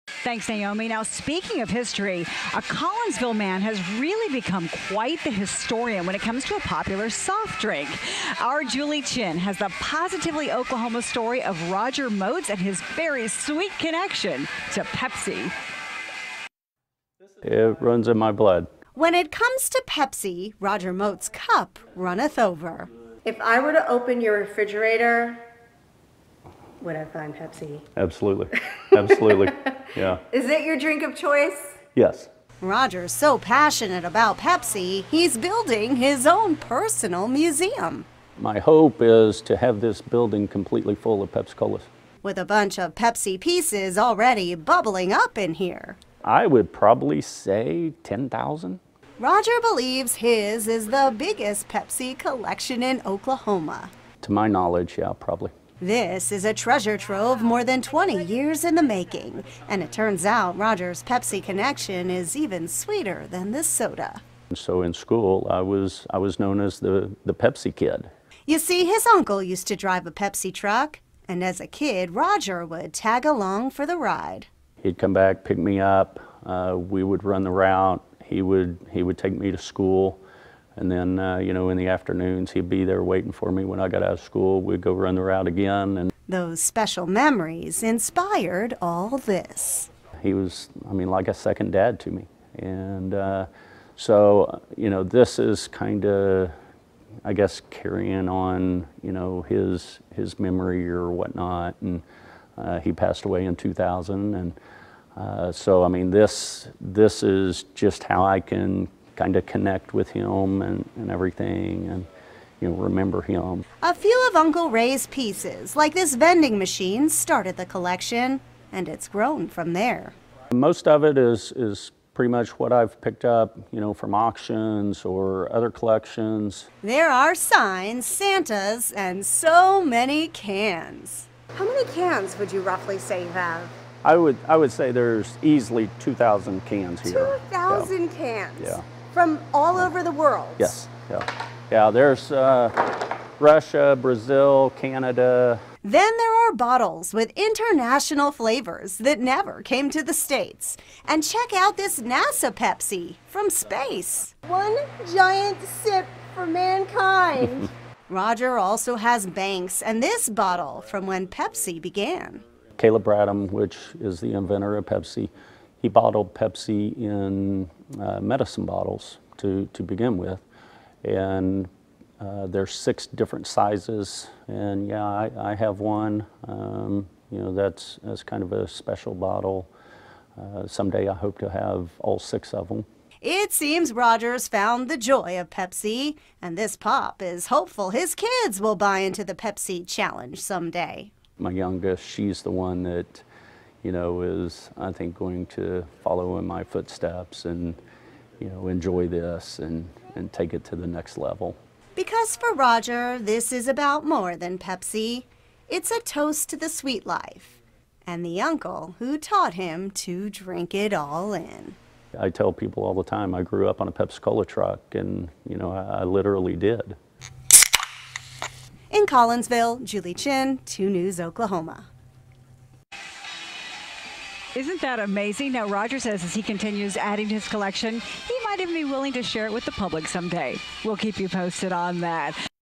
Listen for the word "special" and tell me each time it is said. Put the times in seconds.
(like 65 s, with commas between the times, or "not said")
86 s, 178 s.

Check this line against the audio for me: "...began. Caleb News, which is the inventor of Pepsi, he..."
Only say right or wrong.
wrong.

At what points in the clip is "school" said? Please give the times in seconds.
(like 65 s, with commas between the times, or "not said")
64 s, 79 s, 84 s.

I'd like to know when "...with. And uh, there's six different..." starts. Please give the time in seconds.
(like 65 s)
170 s.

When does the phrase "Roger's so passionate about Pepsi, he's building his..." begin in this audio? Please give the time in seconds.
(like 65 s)
32 s.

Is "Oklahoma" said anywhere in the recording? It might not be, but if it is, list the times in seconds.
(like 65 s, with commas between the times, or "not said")
10 s, 53 s, 221 s.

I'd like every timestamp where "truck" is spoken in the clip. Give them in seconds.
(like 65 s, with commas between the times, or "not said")
70 s, 214 s.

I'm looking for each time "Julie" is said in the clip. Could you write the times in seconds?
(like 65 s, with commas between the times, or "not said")
8 s, 219 s.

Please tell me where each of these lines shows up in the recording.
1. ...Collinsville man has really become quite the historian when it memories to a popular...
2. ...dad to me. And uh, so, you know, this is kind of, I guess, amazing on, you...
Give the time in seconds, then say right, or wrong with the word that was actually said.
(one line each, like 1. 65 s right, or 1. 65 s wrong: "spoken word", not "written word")
1. 2 s wrong: "comes", not "memories"
2. 91 s wrong: "carrying", not "amazing".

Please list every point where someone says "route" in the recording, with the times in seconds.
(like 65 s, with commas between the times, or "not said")
77 s, 85 s.